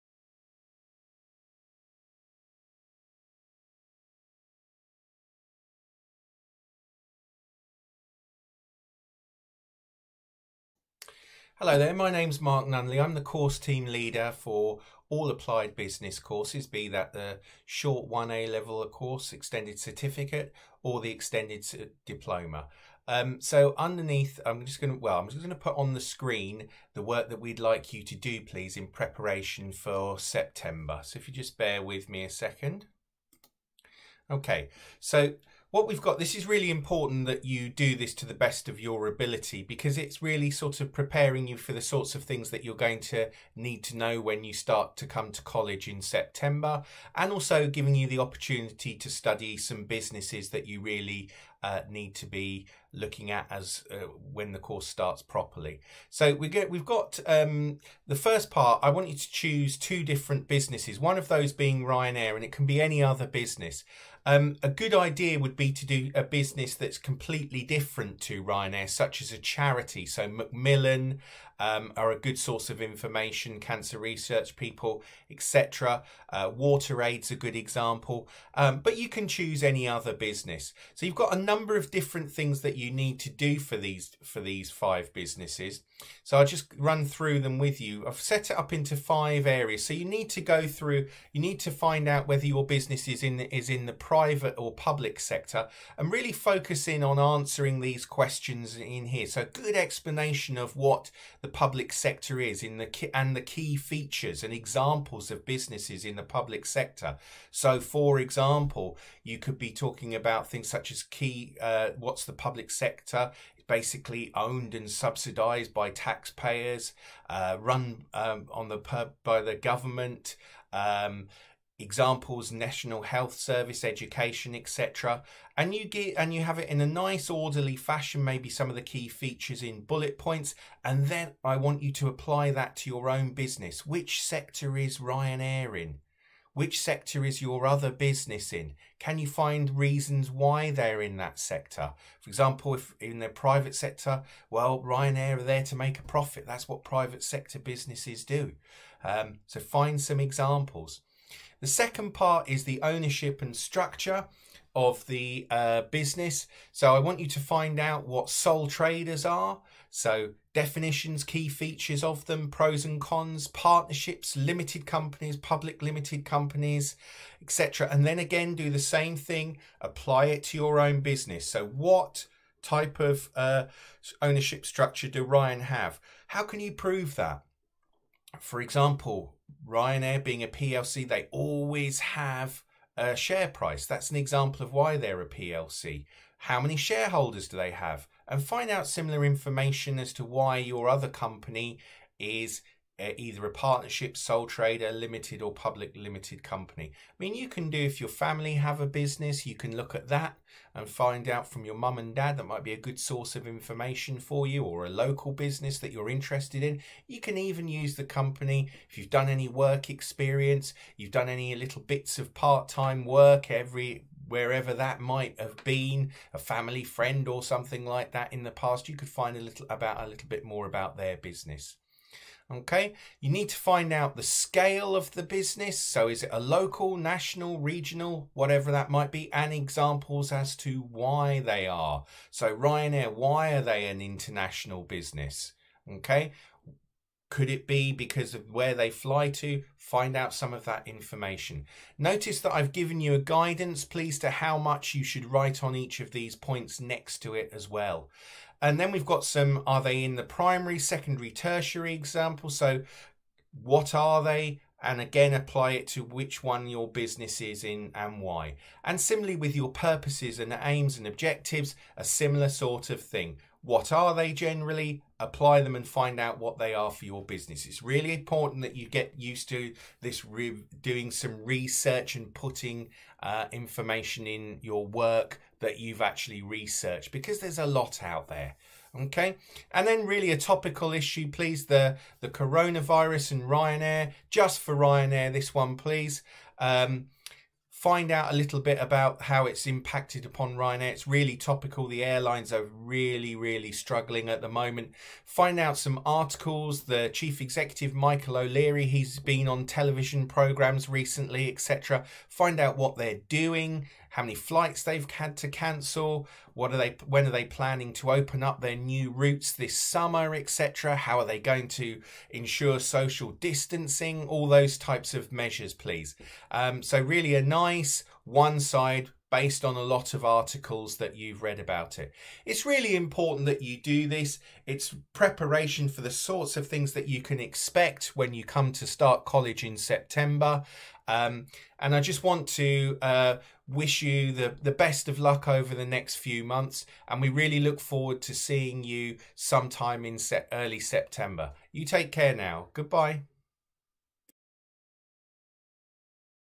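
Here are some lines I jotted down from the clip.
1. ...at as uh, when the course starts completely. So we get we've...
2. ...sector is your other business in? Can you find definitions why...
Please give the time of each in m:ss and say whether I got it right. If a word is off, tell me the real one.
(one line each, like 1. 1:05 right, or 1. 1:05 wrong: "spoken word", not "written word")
1. 0:53 wrong: "properly", not "completely"
2. 2:16 wrong: "reasons", not "definitions".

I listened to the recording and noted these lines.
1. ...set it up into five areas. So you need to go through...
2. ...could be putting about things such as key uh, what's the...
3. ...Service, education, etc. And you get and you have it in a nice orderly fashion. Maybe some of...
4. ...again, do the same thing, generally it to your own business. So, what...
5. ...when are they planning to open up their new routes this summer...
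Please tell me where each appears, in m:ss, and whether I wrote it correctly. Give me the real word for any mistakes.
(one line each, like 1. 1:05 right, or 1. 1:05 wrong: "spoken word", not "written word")
1. 1:28 right
2. 1:49 wrong: "talking", not "putting"
3. 2:03 right
4. 2:48 wrong: "apply", not "generally"
5. 5:07 right.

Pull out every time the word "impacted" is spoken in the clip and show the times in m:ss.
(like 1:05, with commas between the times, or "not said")
4:49.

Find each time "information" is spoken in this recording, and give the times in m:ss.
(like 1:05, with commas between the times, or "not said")
1:12, 3:09, 3:23, 4:00, 4:33.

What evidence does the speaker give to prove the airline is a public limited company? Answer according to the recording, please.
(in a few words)
a share price.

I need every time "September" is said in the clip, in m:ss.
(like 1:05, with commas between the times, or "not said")
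0:30, 0:46, 5:29, 5:40.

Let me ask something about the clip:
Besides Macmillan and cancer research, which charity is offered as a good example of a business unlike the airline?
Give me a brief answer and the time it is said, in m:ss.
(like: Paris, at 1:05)
Water Aid, at 1:16.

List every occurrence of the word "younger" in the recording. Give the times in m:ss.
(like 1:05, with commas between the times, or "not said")
not said.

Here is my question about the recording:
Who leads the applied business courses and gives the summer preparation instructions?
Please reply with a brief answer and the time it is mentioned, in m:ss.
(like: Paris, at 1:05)
Mark Nunneley, at 0:12.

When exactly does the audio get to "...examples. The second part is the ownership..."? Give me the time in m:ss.
2:30.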